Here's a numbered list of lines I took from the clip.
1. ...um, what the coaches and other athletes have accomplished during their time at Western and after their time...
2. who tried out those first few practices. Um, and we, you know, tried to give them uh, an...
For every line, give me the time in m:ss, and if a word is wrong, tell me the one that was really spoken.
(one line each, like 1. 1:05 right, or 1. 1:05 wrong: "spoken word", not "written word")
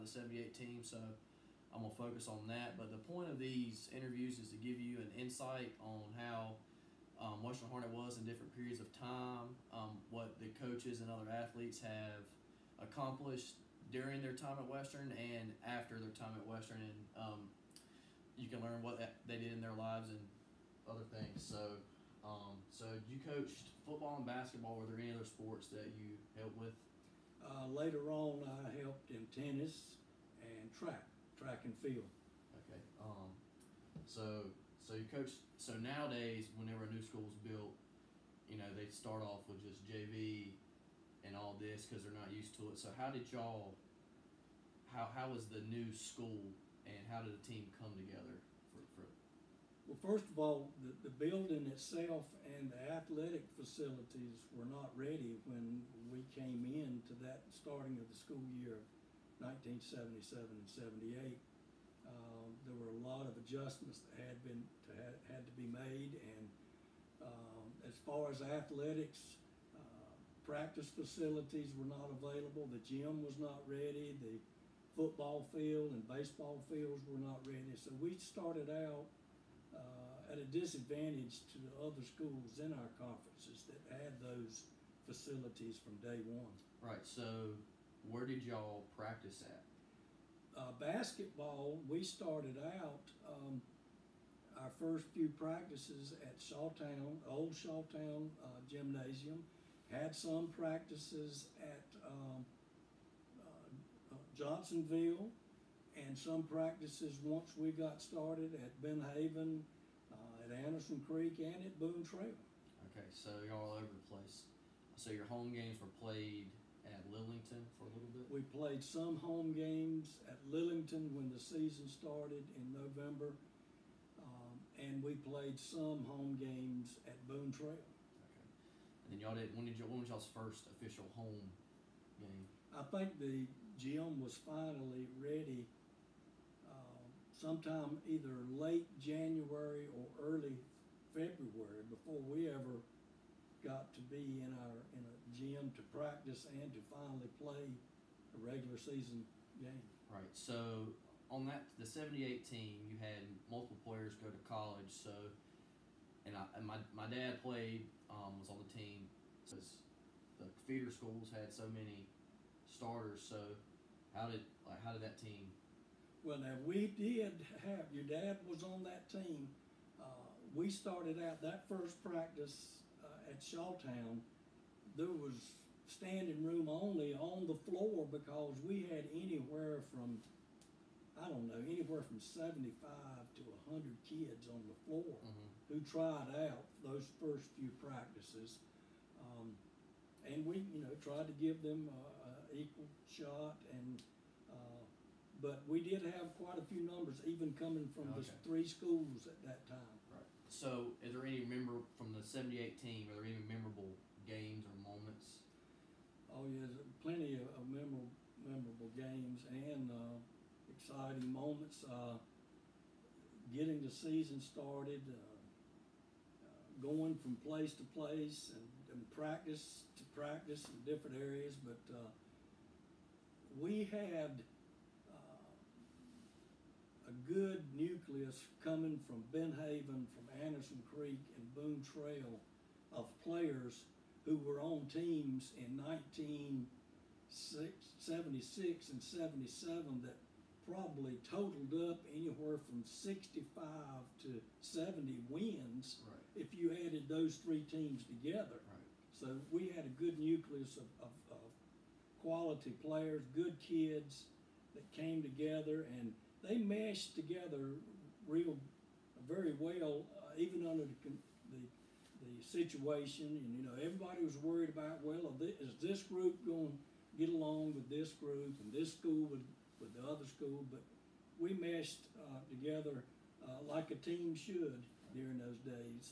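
1. 0:09 right
2. 3:05 right.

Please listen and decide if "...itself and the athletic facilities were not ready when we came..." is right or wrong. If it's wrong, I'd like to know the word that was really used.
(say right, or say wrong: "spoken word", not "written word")
right.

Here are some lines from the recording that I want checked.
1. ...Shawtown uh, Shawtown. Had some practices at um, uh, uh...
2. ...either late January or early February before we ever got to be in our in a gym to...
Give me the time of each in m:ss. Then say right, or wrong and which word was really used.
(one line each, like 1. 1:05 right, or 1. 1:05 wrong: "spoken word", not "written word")
1. 1:37 wrong: "Gymnasium", not "Shawtown"
2. 2:18 right.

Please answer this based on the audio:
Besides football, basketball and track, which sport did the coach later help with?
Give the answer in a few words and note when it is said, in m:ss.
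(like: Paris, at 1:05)
Tennis, at 0:29.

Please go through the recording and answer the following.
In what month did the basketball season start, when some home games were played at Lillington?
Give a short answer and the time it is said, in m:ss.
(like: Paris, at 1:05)
November, at 2:02.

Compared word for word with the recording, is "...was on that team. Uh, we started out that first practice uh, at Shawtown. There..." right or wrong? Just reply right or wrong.
right.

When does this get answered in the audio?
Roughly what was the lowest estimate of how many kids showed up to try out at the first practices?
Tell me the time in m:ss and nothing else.
3:02.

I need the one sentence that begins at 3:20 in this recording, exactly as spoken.
So, is there any member from the '78 team?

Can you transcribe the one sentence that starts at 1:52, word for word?
Okay, so you're all over the place.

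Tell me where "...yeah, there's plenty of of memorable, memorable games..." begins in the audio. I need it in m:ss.
3:26.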